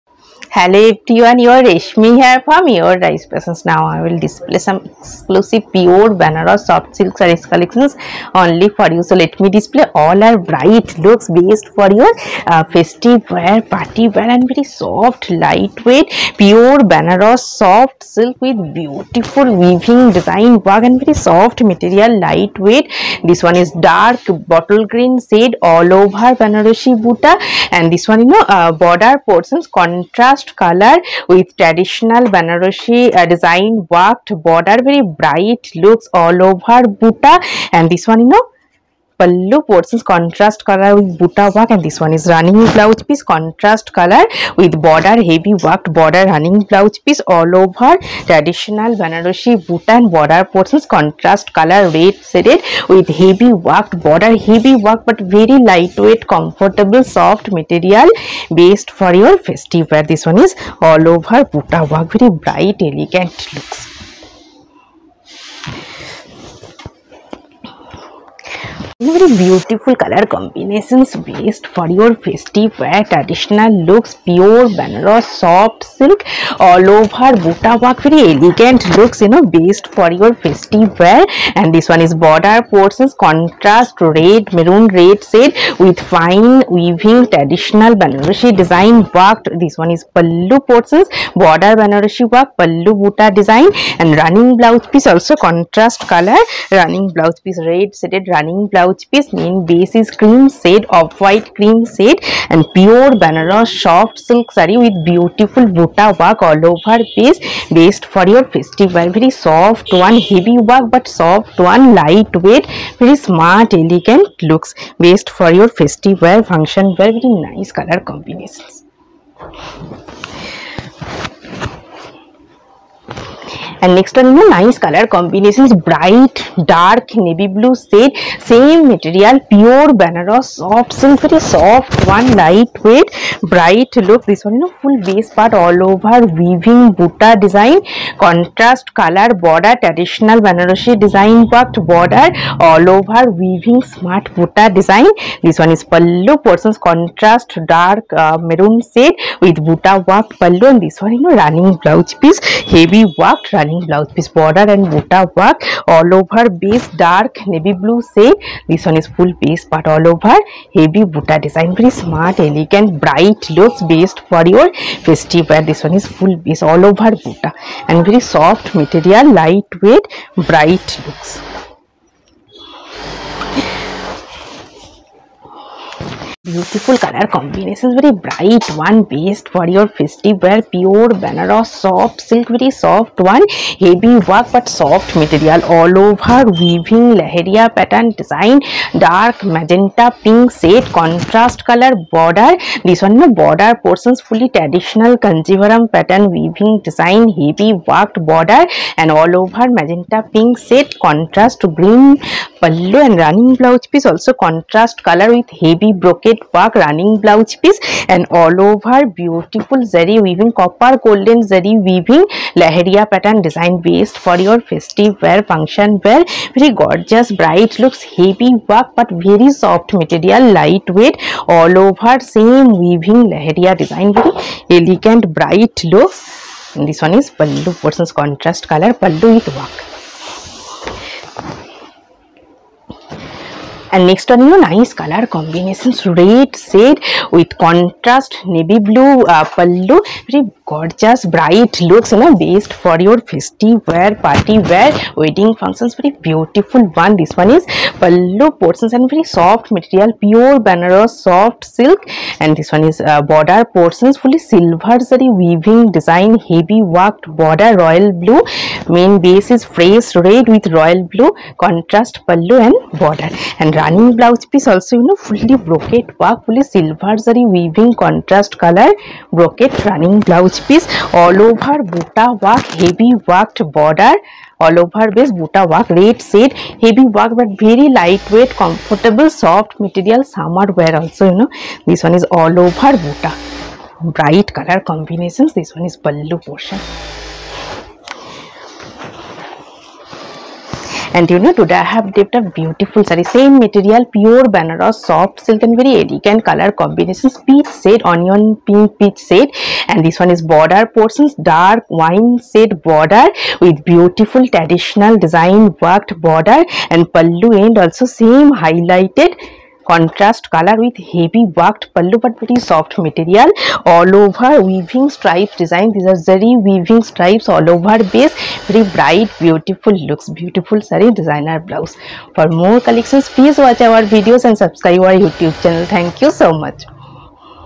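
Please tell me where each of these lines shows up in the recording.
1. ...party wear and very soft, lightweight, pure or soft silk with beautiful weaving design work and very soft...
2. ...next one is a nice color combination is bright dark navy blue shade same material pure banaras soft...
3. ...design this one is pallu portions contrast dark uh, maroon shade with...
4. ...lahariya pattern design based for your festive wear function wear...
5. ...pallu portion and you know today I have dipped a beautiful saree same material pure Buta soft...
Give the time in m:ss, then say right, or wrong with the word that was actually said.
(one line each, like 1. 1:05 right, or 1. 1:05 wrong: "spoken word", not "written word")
1. 0:13 right
2. 2:03 right
3. 2:24 right
4. 3:32 right
5. 4:46 wrong: "Banaras", not "Buta".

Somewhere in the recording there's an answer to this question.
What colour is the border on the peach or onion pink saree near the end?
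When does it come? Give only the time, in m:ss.
5:01.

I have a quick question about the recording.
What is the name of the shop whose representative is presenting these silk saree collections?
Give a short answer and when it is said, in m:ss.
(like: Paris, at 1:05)
Rai's Fashions, at 0:02.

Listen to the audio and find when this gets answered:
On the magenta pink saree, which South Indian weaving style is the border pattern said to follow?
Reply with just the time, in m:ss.
3:15.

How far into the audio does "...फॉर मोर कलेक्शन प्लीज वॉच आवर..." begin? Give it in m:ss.
5:22.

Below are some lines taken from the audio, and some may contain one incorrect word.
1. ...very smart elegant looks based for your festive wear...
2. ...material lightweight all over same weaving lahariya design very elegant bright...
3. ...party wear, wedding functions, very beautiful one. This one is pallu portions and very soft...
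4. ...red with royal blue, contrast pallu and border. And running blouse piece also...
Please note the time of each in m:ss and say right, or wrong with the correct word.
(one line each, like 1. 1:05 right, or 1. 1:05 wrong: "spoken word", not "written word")
1. 1:52 right
2. 3:40 right
3. 4:04 right
4. 4:20 right.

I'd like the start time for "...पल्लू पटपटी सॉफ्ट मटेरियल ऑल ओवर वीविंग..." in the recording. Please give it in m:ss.
5:11.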